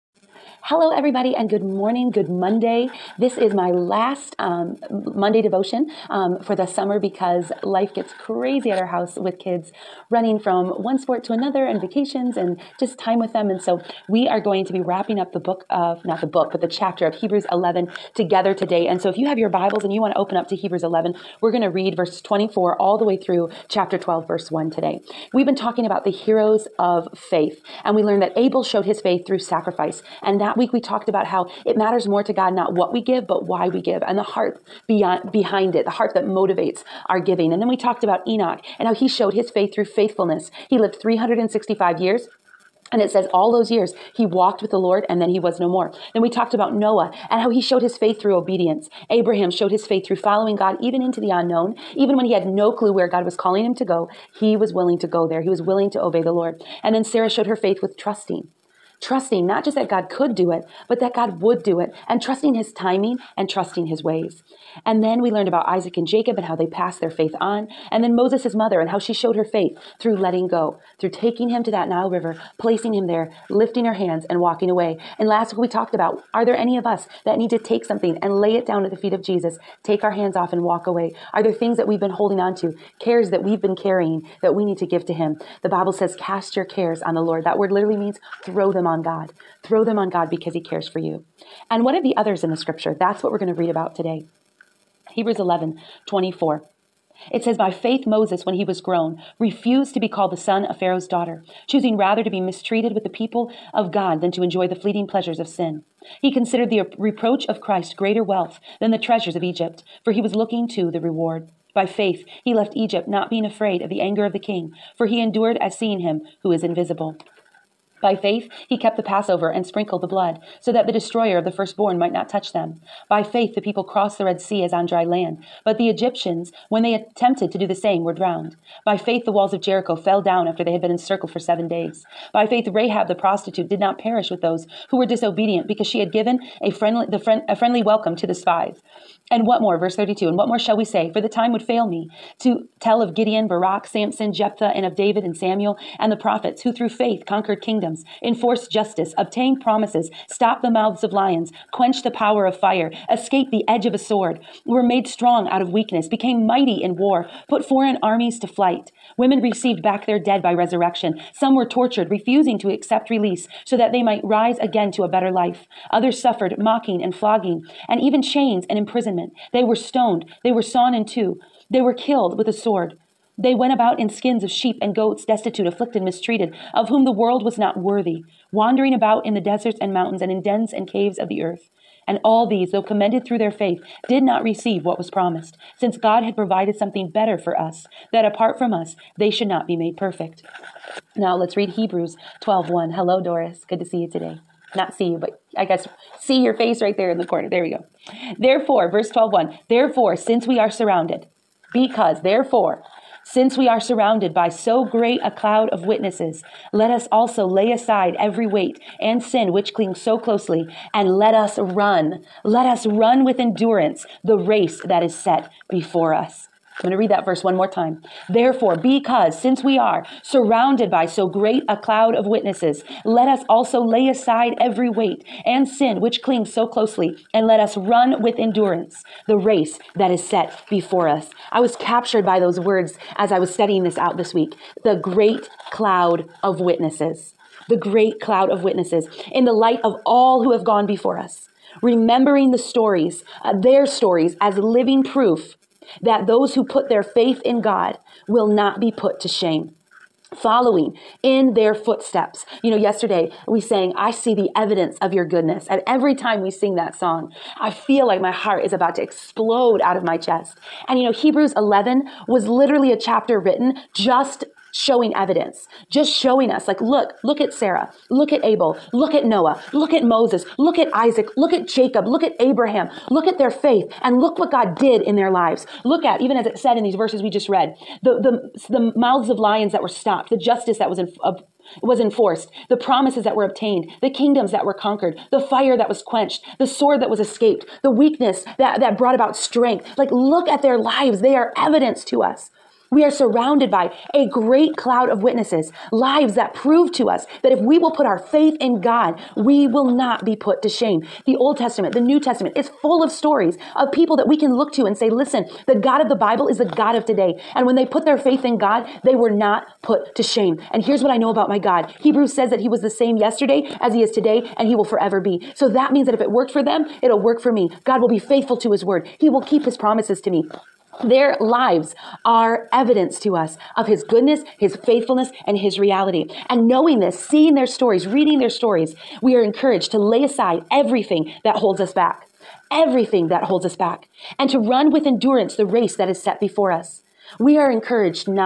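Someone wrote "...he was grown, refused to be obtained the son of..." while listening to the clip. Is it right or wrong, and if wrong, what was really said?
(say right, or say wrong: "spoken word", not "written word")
wrong: "called", not "obtained".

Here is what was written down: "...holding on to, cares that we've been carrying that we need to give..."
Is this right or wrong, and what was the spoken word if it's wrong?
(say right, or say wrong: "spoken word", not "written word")
right.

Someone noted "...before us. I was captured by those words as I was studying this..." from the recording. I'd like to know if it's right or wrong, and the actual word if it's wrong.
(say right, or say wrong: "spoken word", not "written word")
right.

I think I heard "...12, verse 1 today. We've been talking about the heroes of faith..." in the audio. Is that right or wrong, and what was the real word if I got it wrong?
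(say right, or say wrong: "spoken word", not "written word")
right.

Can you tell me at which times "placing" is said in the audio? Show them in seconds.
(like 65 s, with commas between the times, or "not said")
72 s.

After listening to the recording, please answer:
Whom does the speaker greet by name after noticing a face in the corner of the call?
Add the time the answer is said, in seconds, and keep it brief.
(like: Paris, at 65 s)
Doris, at 193 s.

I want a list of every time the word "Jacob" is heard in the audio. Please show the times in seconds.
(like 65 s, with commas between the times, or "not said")
66 s, 271 s.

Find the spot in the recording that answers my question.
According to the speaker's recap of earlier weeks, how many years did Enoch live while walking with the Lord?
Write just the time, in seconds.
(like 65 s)
41 s.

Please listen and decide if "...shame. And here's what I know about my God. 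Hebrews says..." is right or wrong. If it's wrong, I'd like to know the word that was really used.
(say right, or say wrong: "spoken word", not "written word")
right.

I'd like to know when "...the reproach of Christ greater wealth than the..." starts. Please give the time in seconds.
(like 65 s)
106 s.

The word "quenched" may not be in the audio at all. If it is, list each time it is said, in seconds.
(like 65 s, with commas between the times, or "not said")
151 s, 286 s.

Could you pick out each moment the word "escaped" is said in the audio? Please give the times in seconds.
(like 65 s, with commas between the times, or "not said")
153 s, 287 s.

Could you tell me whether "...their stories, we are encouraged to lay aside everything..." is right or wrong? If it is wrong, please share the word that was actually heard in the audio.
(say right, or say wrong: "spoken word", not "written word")
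right.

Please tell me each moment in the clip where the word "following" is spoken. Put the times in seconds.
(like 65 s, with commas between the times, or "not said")
50 s, 250 s.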